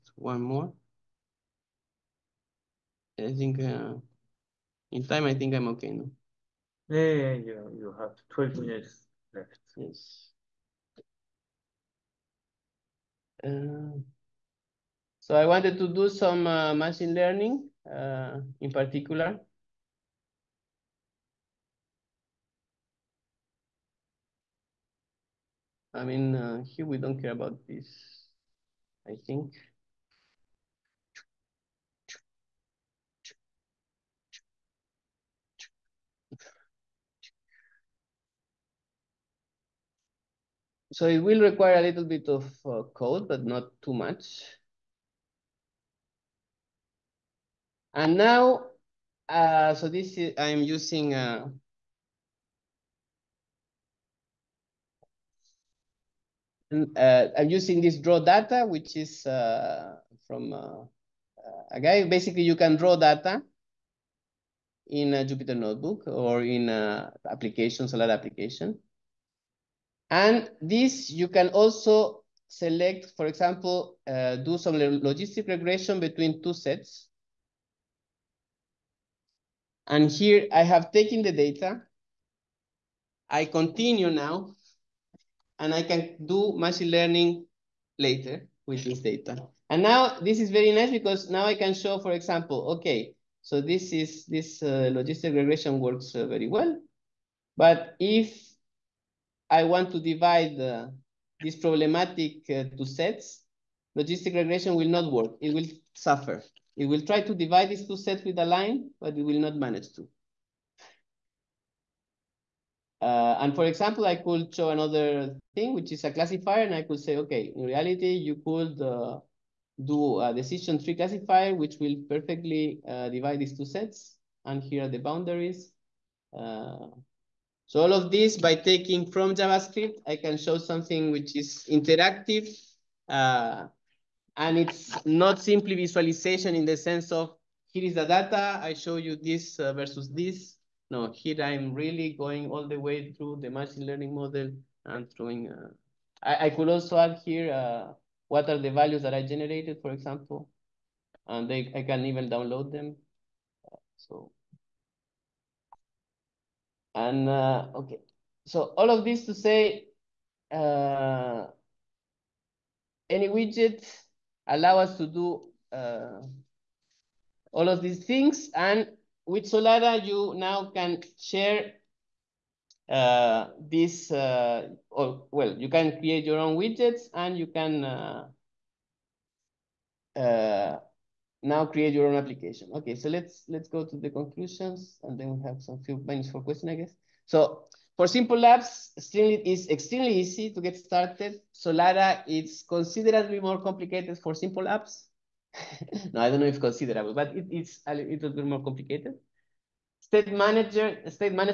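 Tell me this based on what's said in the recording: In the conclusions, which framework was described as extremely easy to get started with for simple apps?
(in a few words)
Streamlit.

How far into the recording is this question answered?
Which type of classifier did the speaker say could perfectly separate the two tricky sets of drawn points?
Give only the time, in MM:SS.
02:00.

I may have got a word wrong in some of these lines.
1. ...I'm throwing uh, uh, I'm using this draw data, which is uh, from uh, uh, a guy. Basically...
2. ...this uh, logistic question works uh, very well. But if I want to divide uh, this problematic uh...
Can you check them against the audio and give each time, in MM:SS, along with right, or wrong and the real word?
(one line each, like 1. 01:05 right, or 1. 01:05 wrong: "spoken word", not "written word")
1. 00:50 wrong: "using", not "throwing"
2. 01:34 wrong: "regression", not "question".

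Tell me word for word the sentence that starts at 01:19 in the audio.
And here I have taken the data.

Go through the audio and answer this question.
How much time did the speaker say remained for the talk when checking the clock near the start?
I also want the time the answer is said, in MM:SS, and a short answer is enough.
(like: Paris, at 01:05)
12 minutes, at 00:08.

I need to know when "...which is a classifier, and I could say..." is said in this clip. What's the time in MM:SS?
01:55.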